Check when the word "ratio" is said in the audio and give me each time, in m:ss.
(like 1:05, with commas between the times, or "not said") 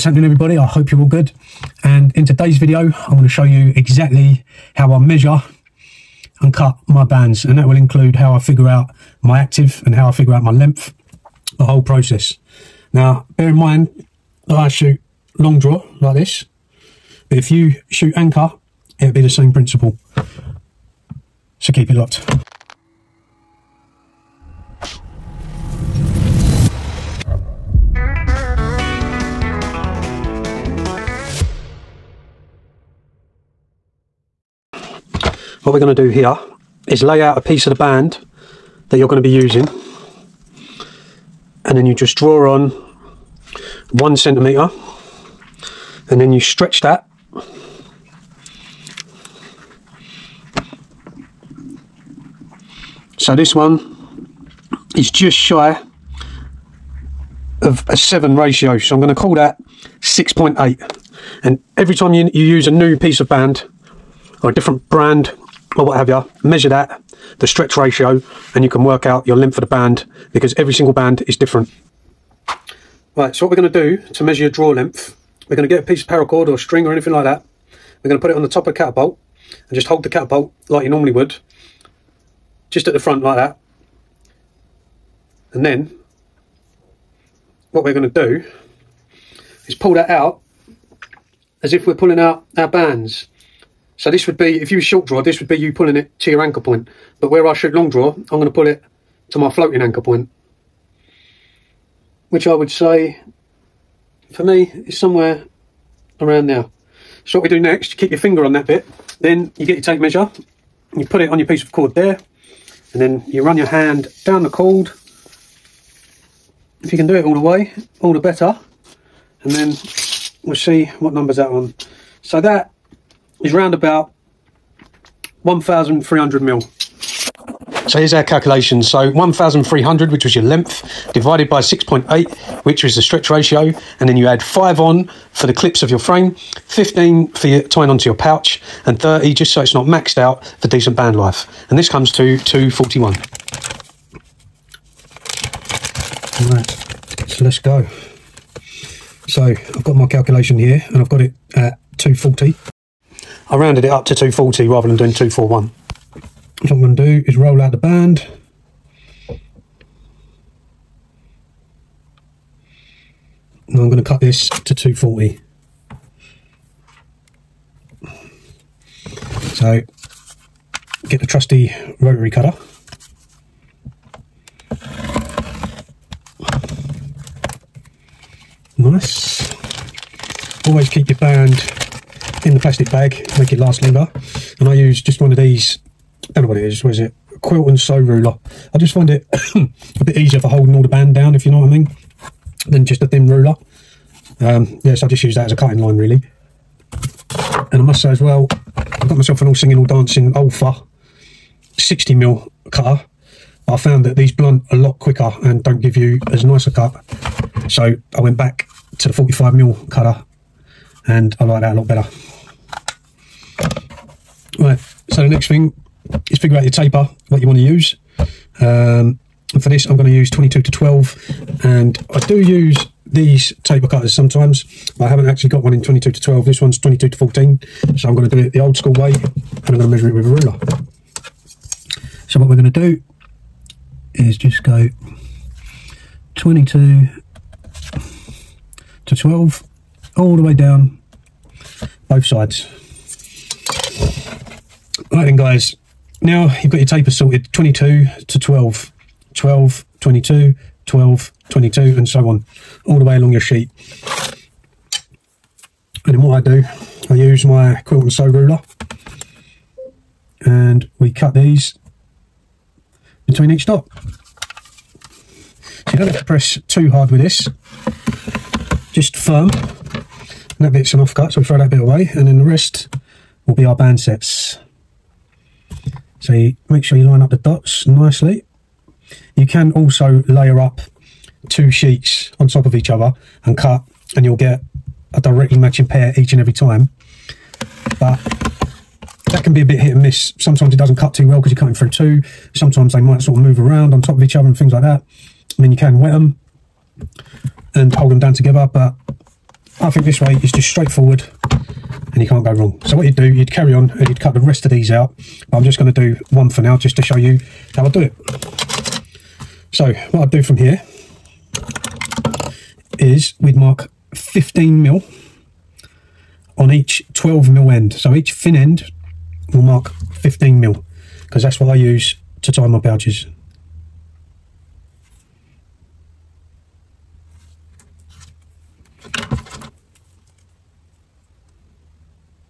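0:58, 1:07, 2:13.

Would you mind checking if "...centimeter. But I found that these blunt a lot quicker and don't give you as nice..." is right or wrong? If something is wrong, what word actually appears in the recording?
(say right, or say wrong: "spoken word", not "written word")
wrong: "cutter", not "centimeter".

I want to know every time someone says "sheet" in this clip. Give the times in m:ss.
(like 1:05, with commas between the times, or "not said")
4:13, 4:41.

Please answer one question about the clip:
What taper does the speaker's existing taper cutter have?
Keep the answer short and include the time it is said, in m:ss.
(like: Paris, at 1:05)
22 to 14, at 3:46.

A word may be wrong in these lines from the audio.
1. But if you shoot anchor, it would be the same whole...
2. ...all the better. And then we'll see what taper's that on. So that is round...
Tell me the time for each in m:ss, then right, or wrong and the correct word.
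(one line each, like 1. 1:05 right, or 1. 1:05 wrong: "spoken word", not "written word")
1. 0:17 wrong: "principle", not "whole"
2. 1:58 wrong: "number", not "taper".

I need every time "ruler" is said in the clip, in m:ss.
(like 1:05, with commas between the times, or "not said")
3:07, 3:13, 3:50, 4:18.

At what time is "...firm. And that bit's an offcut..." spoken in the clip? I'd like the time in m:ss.
4:29.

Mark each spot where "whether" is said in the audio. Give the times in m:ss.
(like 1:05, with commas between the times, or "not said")
not said.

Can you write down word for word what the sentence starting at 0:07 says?
And that will include how I figure out my active and how I figure out my length, the whole process.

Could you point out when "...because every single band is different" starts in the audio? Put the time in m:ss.
1:10.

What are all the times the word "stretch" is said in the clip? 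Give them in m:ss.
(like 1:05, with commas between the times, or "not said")
0:46, 1:07, 2:13.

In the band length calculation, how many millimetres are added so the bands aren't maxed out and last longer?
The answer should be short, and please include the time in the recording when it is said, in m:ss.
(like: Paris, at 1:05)
30, at 2:19.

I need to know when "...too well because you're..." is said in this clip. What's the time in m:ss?
4:51.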